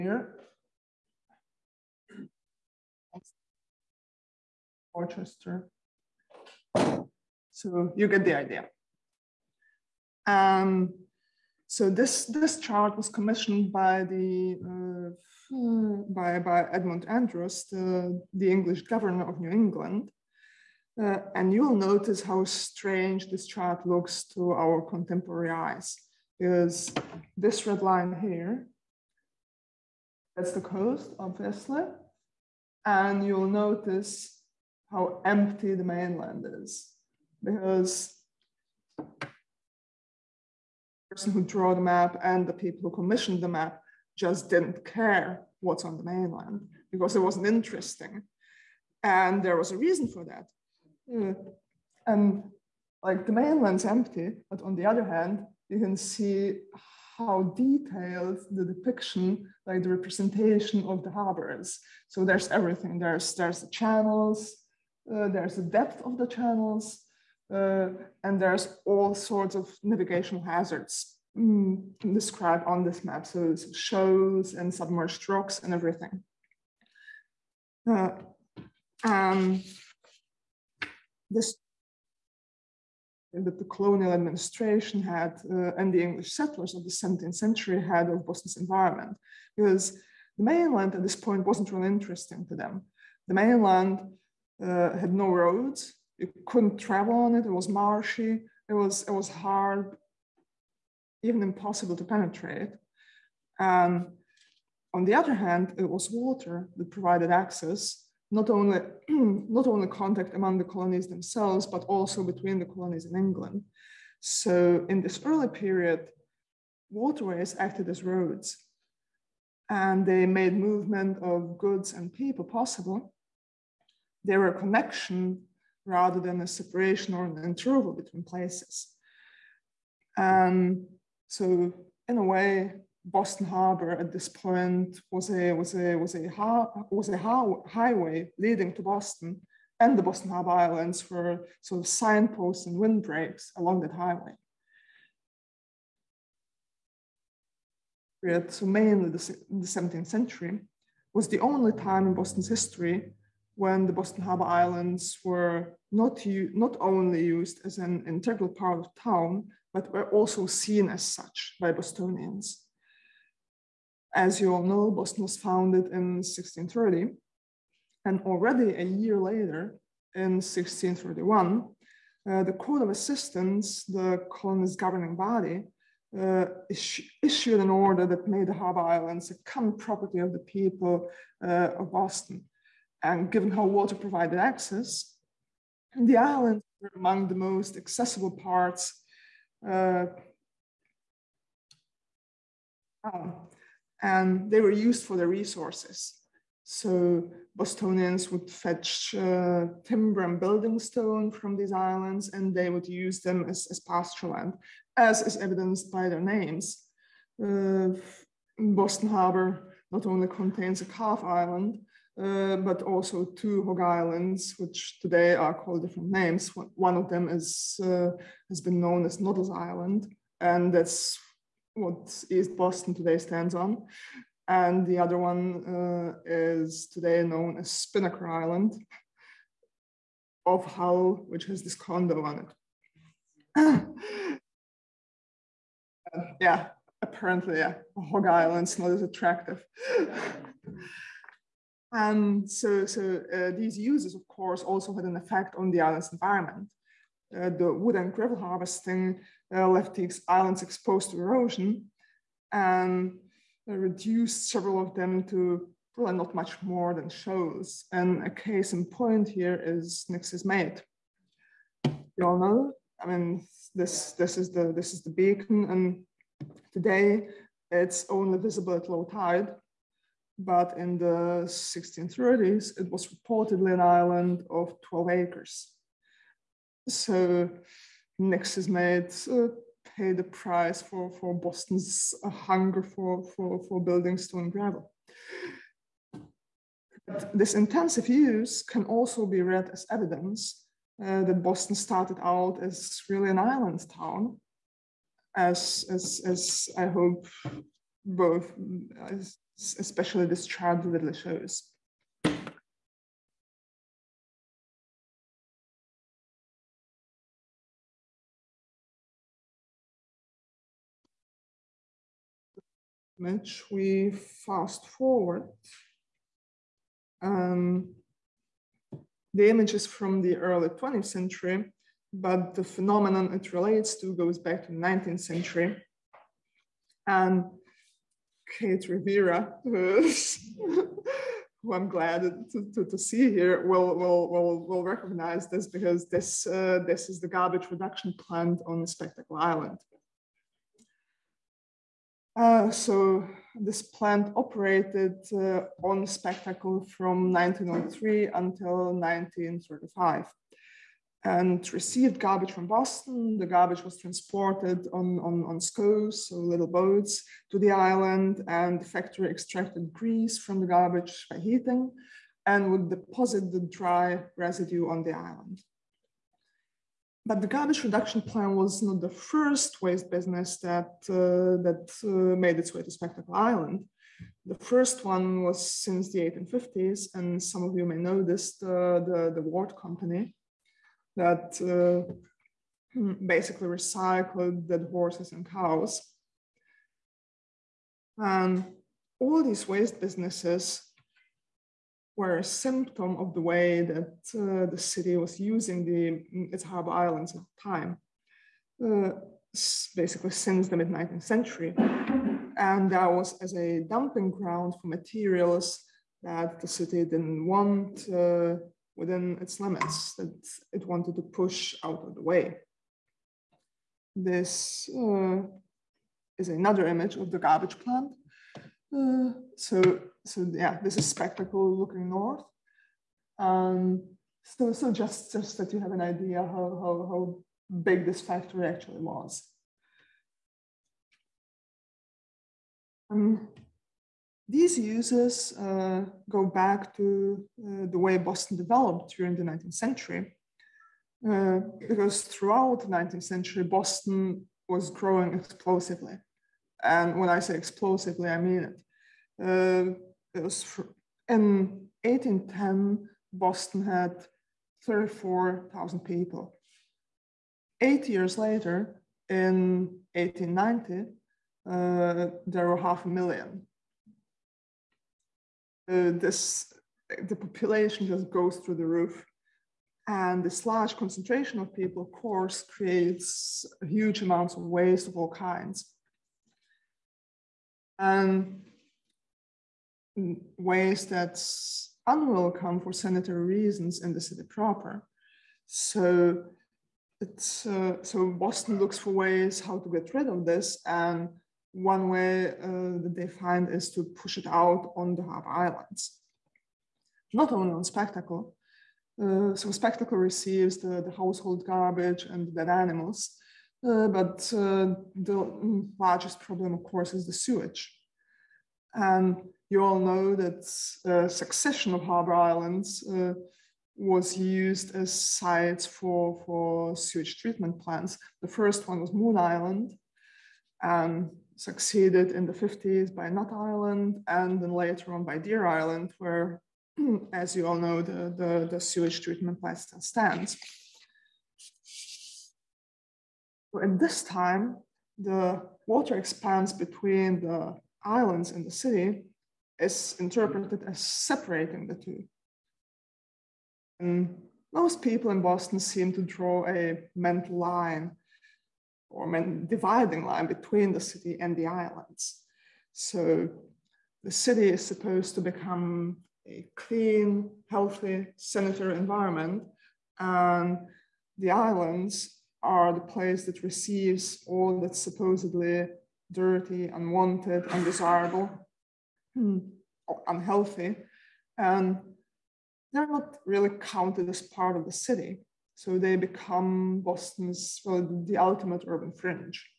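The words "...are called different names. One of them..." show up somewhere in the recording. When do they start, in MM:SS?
03:35.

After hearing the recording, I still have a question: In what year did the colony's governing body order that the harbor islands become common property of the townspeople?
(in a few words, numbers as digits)
1631.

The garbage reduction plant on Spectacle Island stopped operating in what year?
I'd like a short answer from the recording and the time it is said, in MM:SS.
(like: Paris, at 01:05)
1935, at 05:48.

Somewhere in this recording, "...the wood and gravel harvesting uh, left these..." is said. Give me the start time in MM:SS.
04:07.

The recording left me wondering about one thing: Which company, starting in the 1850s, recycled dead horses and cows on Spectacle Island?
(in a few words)
Ward Company.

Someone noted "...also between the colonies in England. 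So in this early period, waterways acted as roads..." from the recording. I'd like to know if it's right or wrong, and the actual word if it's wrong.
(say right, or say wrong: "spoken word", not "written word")
right.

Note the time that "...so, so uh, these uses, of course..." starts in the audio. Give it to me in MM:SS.
04:02.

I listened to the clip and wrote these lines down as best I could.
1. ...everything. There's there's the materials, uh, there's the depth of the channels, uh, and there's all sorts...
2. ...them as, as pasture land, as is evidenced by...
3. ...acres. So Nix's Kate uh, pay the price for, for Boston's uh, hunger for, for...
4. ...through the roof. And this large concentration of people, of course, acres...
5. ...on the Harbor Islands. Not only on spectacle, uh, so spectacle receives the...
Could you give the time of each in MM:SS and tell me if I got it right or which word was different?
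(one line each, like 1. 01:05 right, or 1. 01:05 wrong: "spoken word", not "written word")
1. 01:02 wrong: "channels", not "materials"
2. 03:23 right
3. 04:35 wrong: "Mate", not "Kate"
4. 07:48 wrong: "creates", not "acres"
5. 08:14 right.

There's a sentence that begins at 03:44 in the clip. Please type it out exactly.
And the other one uh, is today known as Spinnaker Island of Hull, which has this condo on it.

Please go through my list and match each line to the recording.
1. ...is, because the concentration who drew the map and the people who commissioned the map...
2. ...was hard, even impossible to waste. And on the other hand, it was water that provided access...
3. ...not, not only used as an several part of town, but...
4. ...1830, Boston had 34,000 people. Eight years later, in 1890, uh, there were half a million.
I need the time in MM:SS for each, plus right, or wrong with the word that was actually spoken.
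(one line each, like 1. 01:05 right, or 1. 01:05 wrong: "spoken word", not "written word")
1. 00:36 wrong: "person", not "concentration"
2. 01:39 wrong: "penetrate", not "waste"
3. 02:35 wrong: "integral", not "several"
4. 07:32 wrong: "1810", not "1830".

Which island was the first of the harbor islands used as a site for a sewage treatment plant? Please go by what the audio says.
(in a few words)
Moon Island.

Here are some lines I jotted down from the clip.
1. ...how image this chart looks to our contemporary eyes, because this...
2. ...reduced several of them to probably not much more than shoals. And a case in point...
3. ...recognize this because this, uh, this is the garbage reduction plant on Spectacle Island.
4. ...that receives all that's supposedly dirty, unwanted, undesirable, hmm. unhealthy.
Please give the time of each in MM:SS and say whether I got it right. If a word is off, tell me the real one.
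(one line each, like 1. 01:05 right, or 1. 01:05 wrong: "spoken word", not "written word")
1. 00:22 wrong: "strange", not "image"
2. 04:13 right
3. 05:34 right
4. 09:23 right.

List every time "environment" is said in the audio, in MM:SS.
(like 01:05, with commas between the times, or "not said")
01:28, 04:06, 09:18.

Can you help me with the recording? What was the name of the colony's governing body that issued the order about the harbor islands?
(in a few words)
Court of Assistants.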